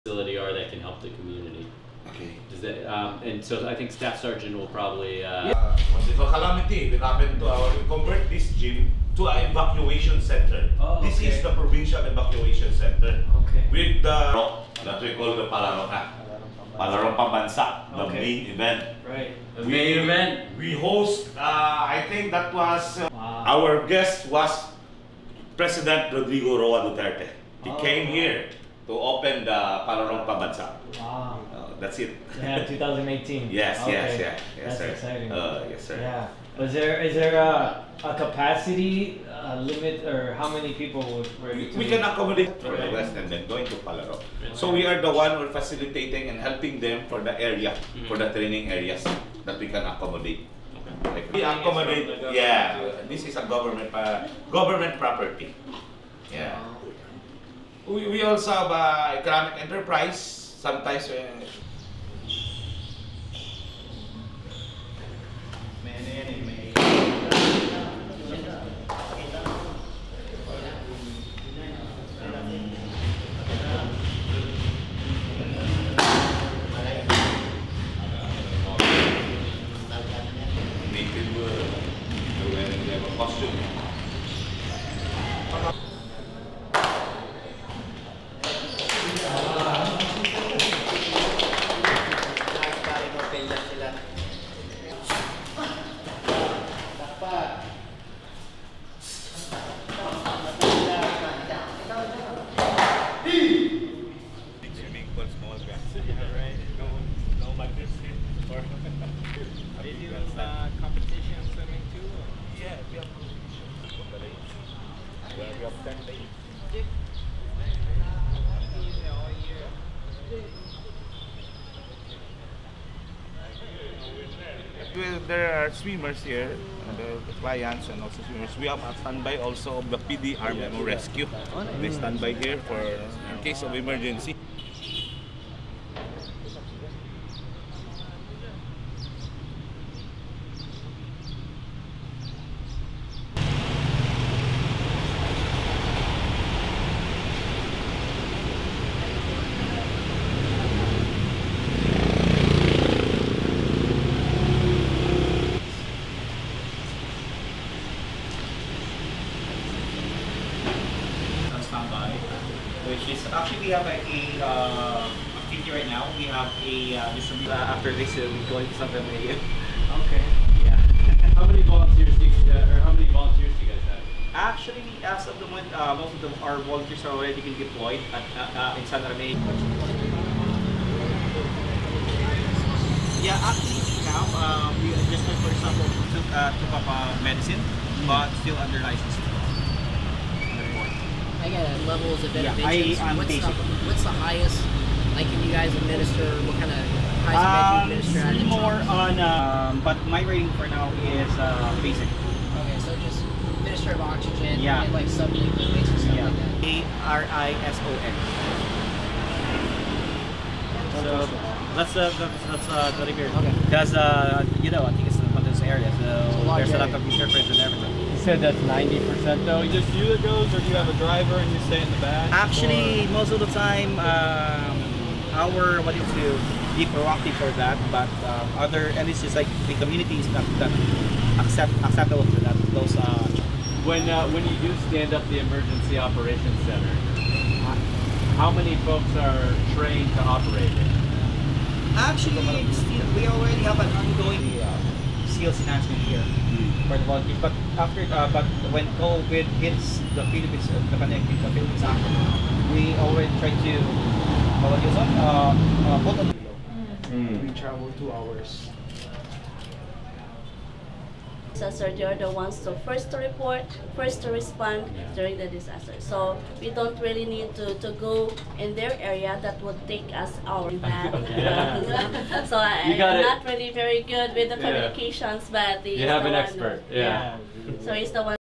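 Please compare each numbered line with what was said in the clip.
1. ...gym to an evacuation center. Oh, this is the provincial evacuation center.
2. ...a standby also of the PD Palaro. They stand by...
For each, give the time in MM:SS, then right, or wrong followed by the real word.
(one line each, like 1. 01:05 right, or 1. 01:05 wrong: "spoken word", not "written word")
1. 00:08 right
2. 02:08 wrong: "Rescue", not "Palaro".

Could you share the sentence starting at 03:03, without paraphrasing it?
Yeah, actually now we just like for example took, took up medicine, but still under license.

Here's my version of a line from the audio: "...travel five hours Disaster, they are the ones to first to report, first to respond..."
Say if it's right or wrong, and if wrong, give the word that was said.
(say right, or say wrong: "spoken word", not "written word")
wrong: "two", not "five".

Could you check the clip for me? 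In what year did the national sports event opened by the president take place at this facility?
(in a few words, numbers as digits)
2018.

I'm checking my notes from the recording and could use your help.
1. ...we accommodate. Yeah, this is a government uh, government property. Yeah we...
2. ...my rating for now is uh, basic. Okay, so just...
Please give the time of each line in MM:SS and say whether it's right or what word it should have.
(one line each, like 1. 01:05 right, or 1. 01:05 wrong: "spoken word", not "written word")
1. 00:51 right
2. 03:20 right.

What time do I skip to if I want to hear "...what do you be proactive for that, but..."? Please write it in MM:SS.
03:45.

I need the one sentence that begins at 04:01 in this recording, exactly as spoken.
Actually, we already have an skills enhancement here mm.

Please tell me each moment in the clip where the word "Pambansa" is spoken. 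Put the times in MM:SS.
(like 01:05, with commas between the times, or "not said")
00:17, 00:30.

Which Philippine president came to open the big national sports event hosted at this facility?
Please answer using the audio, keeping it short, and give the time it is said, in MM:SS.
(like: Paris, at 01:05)
Rodrigo Roa Duterte, at 00:26.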